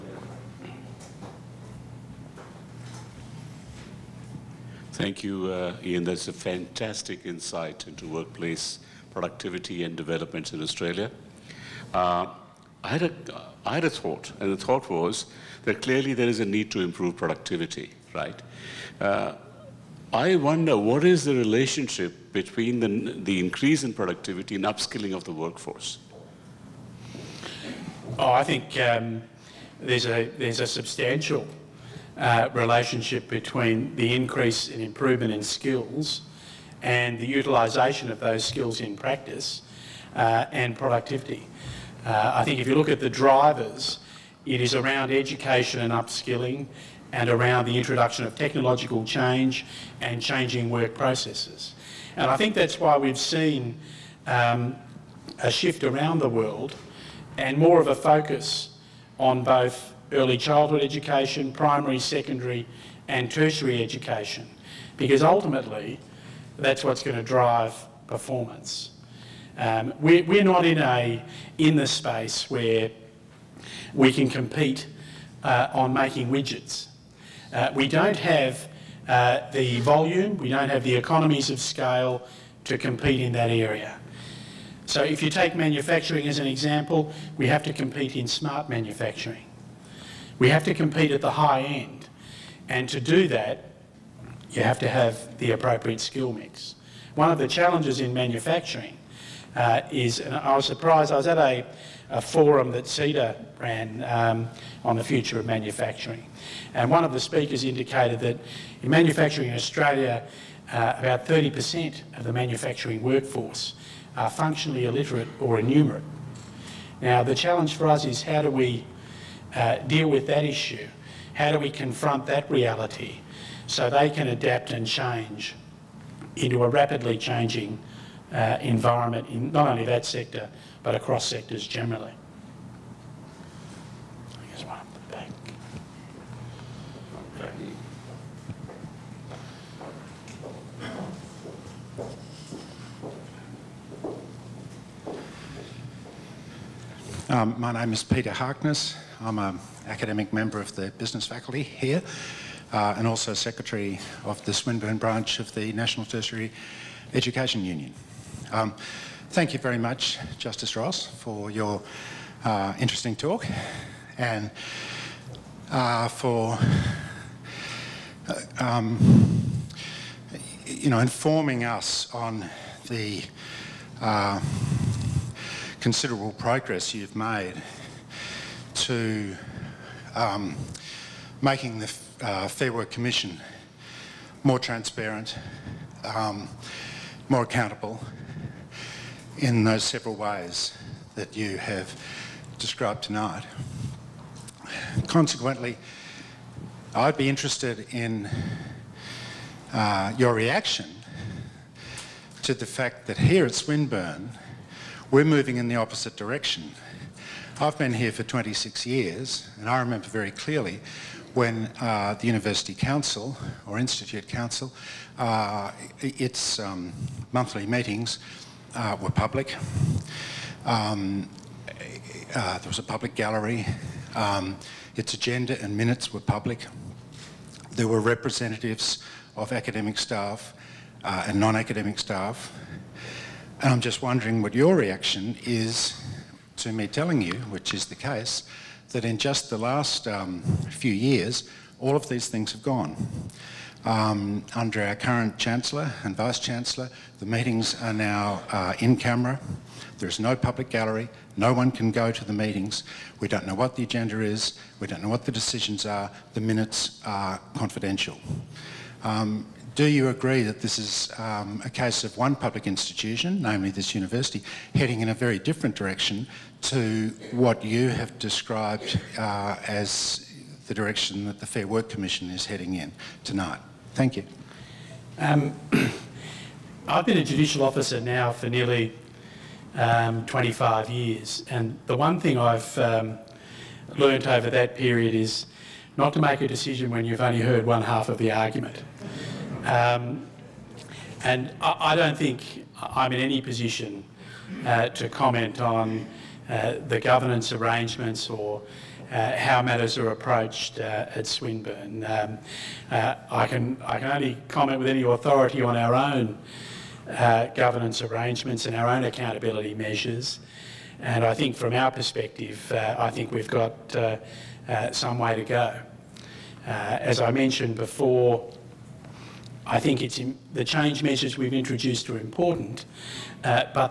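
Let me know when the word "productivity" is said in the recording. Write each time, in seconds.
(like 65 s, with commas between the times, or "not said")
9 s, 17 s, 23 s, 40 s.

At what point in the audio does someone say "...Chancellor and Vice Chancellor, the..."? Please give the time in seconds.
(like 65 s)
245 s.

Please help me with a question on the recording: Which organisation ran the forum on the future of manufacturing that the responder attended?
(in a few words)
CEDA.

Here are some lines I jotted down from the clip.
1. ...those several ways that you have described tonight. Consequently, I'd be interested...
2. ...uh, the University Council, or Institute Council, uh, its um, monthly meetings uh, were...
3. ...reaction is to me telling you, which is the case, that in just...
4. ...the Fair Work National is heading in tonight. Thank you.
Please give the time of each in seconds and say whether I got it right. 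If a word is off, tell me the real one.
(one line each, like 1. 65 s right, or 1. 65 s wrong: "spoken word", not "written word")
1. 189 s right
2. 211 s right
3. 234 s right
4. 271 s wrong: "Commission", not "National".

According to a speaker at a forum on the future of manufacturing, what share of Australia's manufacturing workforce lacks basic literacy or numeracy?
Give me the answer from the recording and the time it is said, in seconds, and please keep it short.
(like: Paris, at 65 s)
30%, at 111 s.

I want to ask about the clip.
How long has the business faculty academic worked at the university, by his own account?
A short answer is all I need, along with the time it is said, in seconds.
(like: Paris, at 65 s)
26 years, at 208 s.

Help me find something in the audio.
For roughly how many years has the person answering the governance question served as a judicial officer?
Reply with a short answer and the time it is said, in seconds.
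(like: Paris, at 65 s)
25 years, at 280 s.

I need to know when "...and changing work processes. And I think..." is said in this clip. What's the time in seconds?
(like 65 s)
50 s.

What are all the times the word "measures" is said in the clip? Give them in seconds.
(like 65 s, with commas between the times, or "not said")
309 s, 321 s.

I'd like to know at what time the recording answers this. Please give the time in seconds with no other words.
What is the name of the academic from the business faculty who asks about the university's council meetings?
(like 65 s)
148 s.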